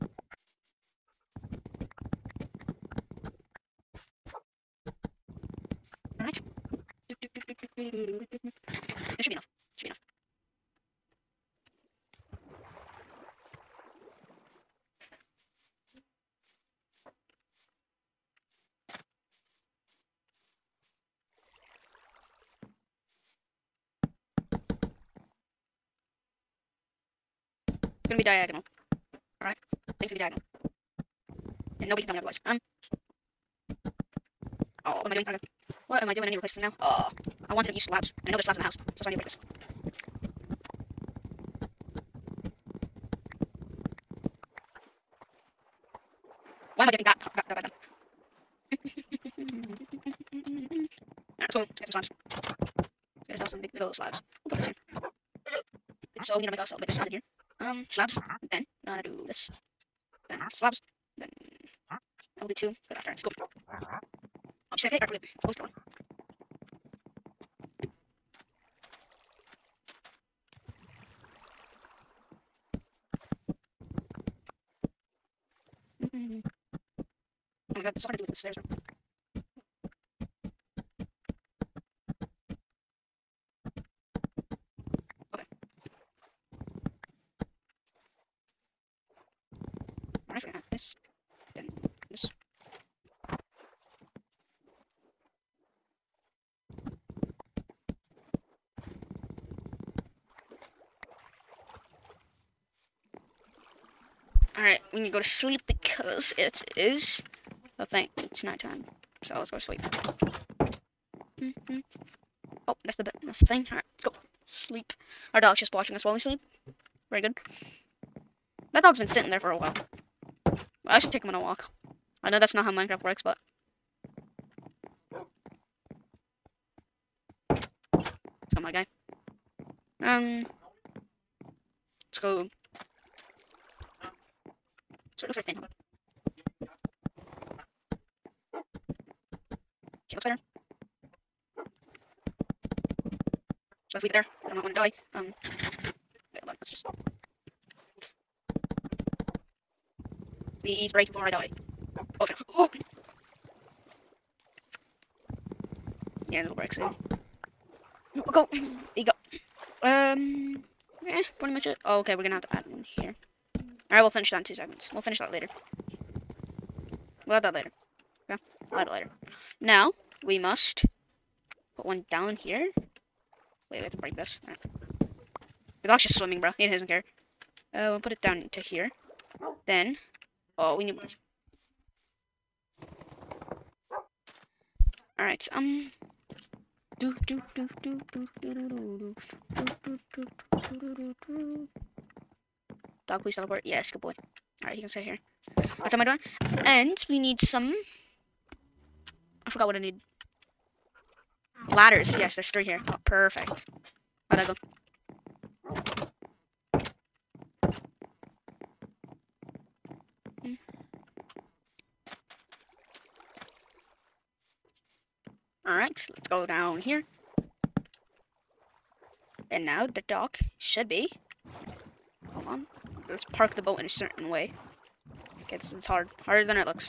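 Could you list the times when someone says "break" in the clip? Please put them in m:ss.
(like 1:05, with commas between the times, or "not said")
0:39, 2:30, 2:36, 2:53.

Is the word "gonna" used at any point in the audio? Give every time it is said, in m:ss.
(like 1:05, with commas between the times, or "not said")
0:28, 0:58, 1:30, 2:42.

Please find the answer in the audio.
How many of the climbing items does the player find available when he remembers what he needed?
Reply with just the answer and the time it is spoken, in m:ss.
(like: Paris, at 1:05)
3, at 3:22.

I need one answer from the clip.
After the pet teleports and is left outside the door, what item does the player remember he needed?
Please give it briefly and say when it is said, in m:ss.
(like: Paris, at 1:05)
Ladders, at 3:21.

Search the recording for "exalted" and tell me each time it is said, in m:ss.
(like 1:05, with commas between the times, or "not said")
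not said.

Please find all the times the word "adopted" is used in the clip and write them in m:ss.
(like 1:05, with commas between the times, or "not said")
not said.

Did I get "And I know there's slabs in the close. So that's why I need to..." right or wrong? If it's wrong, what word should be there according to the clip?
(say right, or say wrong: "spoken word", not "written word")
wrong: "house", not "close".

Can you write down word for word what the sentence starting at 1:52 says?
Oh, that's the that's the thing.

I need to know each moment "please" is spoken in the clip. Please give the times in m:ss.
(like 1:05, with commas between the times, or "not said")
2:30, 3:13.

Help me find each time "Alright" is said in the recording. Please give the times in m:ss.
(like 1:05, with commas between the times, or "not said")
1:05, 1:30, 1:44, 1:53, 2:43, 3:14, 3:35.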